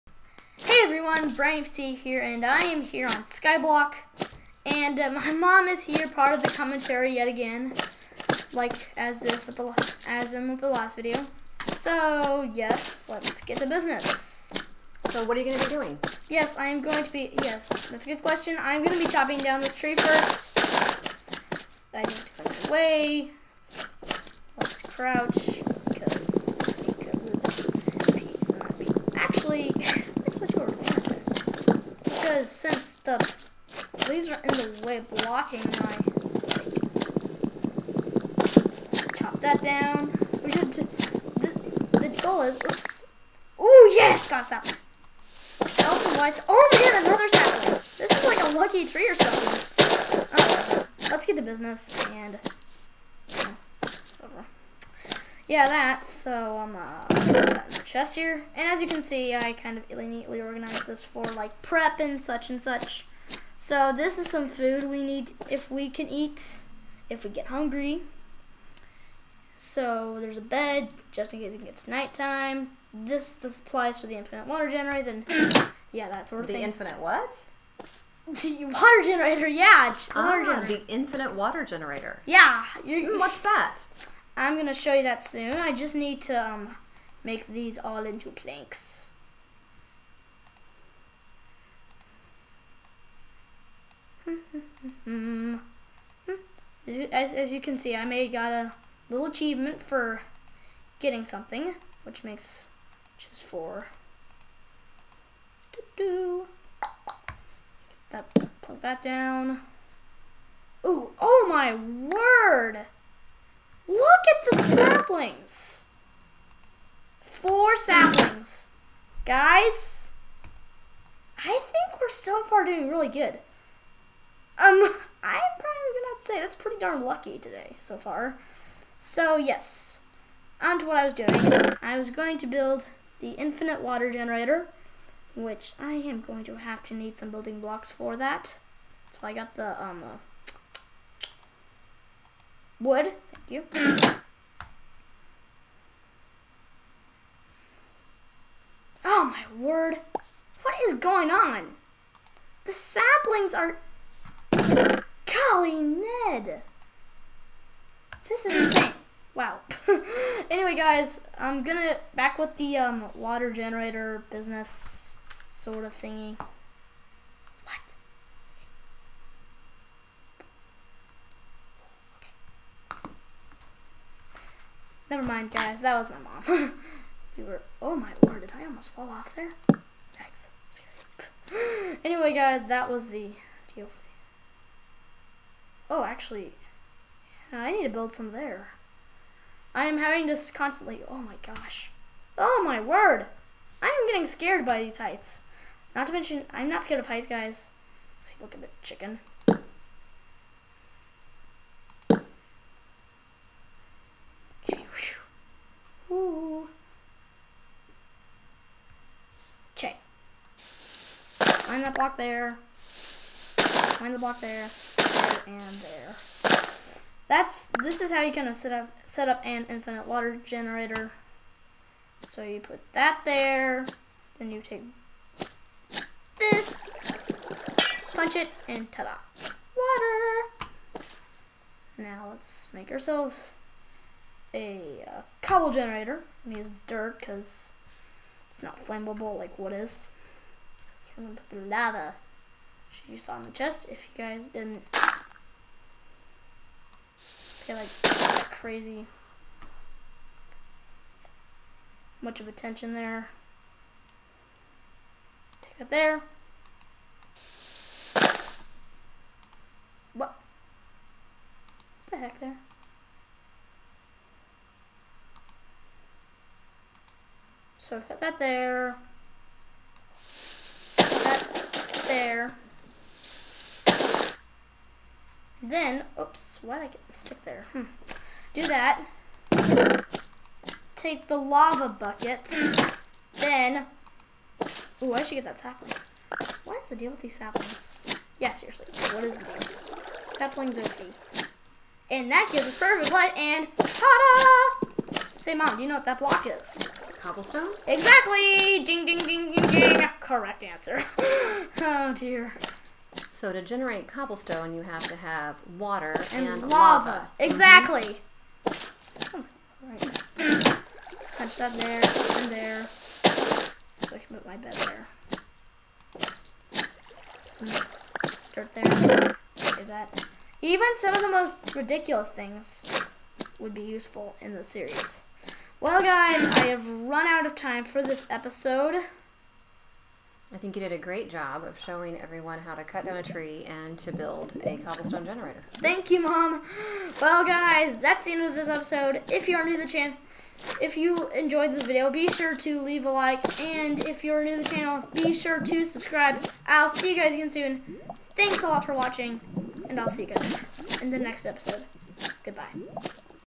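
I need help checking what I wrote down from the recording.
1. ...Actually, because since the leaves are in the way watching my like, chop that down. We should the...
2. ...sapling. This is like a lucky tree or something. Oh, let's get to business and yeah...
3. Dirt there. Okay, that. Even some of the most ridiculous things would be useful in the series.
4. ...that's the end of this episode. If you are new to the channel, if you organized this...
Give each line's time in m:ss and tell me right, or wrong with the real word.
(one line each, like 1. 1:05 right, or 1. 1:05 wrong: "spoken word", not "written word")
1. 0:29 wrong: "blocking", not "watching"
2. 0:47 right
3. 5:18 right
4. 5:38 wrong: "enjoyed", not "organized".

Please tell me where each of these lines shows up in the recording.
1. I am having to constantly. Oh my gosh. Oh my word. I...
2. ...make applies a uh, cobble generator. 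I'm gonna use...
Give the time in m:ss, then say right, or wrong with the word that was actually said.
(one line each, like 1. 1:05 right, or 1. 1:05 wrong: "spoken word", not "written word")
1. 3:09 right
2. 3:52 wrong: "ourselves", not "applies".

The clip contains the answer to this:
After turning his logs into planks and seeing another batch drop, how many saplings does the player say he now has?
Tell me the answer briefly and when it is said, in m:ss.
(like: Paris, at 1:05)
4, at 1:57.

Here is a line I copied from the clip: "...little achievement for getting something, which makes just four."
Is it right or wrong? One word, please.
right.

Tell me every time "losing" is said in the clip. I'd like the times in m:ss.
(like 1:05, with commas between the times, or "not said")
not said.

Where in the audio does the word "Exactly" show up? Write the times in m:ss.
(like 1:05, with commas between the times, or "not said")
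4:57, 5:07.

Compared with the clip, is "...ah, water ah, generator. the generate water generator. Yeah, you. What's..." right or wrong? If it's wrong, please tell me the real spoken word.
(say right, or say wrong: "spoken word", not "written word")
wrong: "infinite", not "generate".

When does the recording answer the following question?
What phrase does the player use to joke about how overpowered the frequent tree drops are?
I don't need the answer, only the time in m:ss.
4:50.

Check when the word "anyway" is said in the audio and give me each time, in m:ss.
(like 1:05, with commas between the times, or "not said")
2:40, 3:02.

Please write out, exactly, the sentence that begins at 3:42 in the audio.
So you put that there, then you take this, punch it, and ta-da.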